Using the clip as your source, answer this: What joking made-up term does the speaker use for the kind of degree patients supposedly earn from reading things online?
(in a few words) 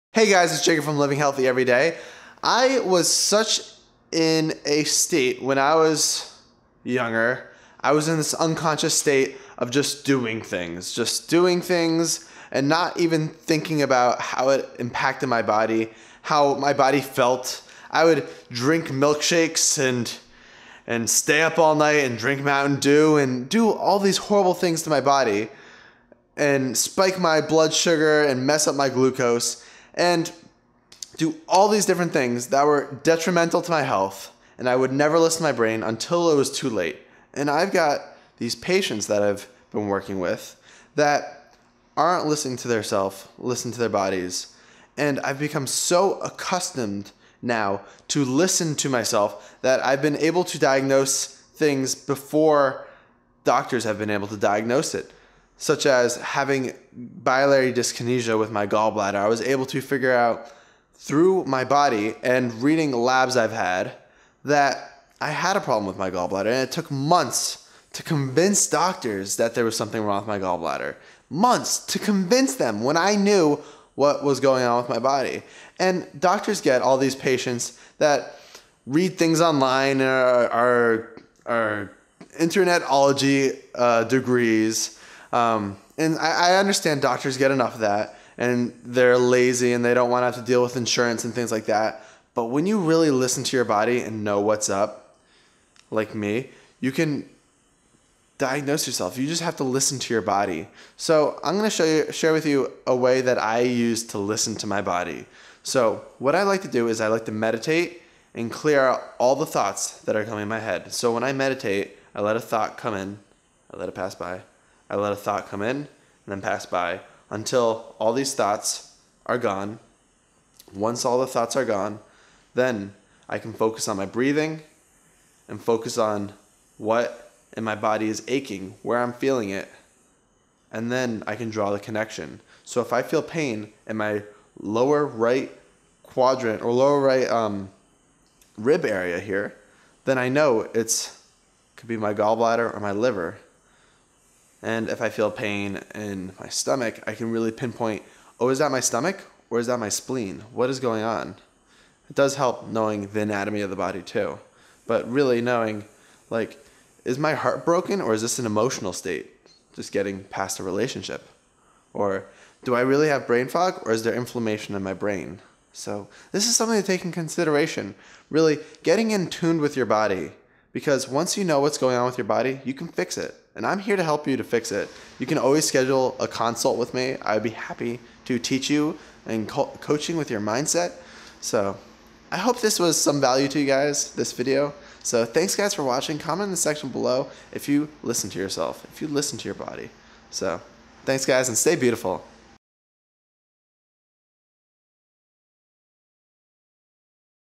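internetology.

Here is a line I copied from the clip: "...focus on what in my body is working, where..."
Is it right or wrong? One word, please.
wrong.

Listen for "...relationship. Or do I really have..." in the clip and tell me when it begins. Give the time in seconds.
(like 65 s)
160 s.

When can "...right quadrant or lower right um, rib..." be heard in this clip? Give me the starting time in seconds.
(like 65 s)
135 s.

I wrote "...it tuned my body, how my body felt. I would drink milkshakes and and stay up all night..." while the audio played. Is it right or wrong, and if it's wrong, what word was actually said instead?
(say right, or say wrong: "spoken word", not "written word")
wrong: "impacted", not "tuned".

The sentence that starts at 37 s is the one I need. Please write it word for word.
And I've got these patients that I've been working with that aren't listening to their self, listen to their bodies.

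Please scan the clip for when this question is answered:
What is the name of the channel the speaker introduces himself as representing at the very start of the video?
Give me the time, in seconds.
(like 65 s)
0 s.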